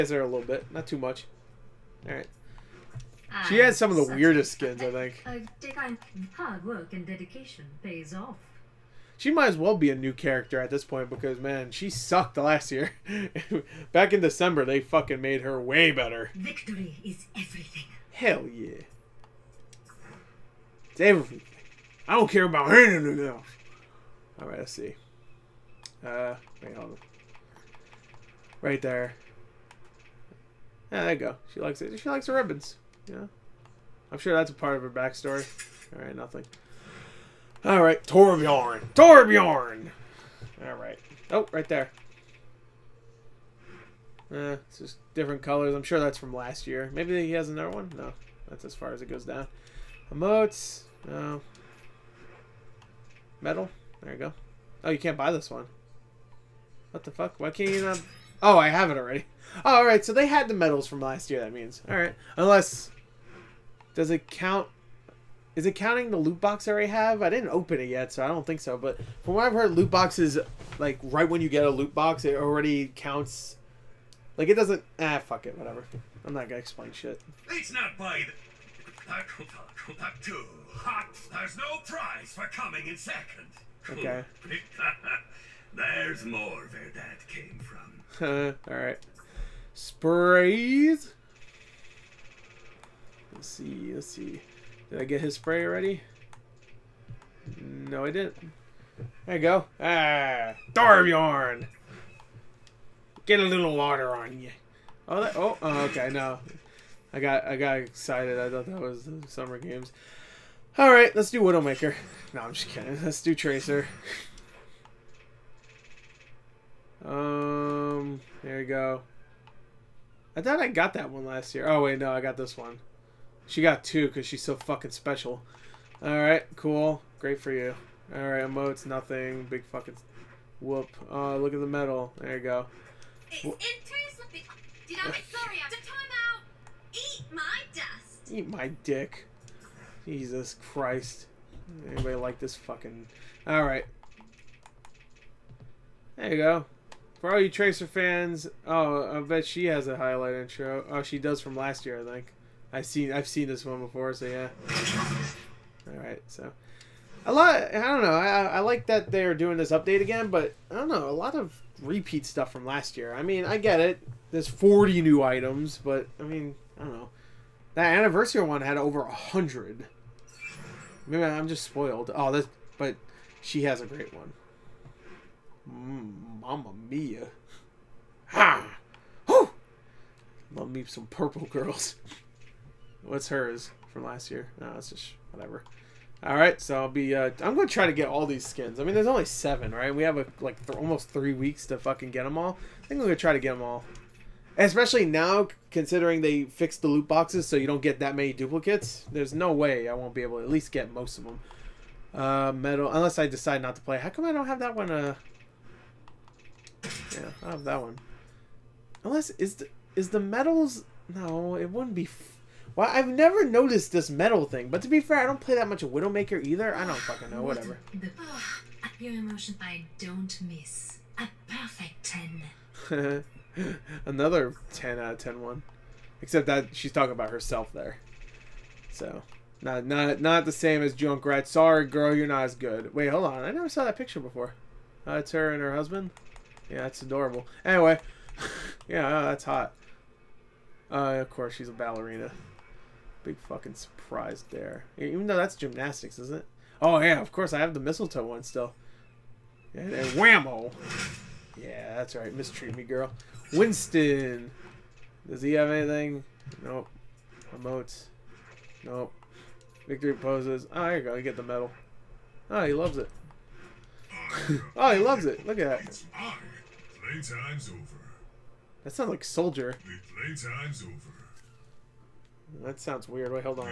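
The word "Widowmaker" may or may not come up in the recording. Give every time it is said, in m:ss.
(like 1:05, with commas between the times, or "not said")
1:51, 3:35.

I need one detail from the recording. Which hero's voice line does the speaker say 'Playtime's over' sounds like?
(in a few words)
Soldier.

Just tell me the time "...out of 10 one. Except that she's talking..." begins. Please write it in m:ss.
3:44.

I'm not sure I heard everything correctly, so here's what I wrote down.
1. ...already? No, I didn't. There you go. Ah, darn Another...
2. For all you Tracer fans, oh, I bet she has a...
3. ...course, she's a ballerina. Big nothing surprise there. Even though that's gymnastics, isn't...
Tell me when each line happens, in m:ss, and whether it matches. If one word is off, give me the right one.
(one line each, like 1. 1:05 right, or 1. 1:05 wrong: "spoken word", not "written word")
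1. 1:35 wrong: "Get", not "Another"
2. 2:27 right
3. 4:01 wrong: "fucking", not "nothing".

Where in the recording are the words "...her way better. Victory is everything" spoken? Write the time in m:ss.
0:15.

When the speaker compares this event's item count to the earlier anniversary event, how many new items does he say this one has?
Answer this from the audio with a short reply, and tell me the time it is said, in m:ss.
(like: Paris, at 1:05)
40, at 2:44.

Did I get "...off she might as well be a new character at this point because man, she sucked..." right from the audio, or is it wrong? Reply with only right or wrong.
right.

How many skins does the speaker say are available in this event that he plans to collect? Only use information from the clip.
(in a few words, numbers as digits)
7.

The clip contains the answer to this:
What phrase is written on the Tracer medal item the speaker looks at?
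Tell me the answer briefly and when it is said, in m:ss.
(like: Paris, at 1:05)
Eat my dust, at 2:13.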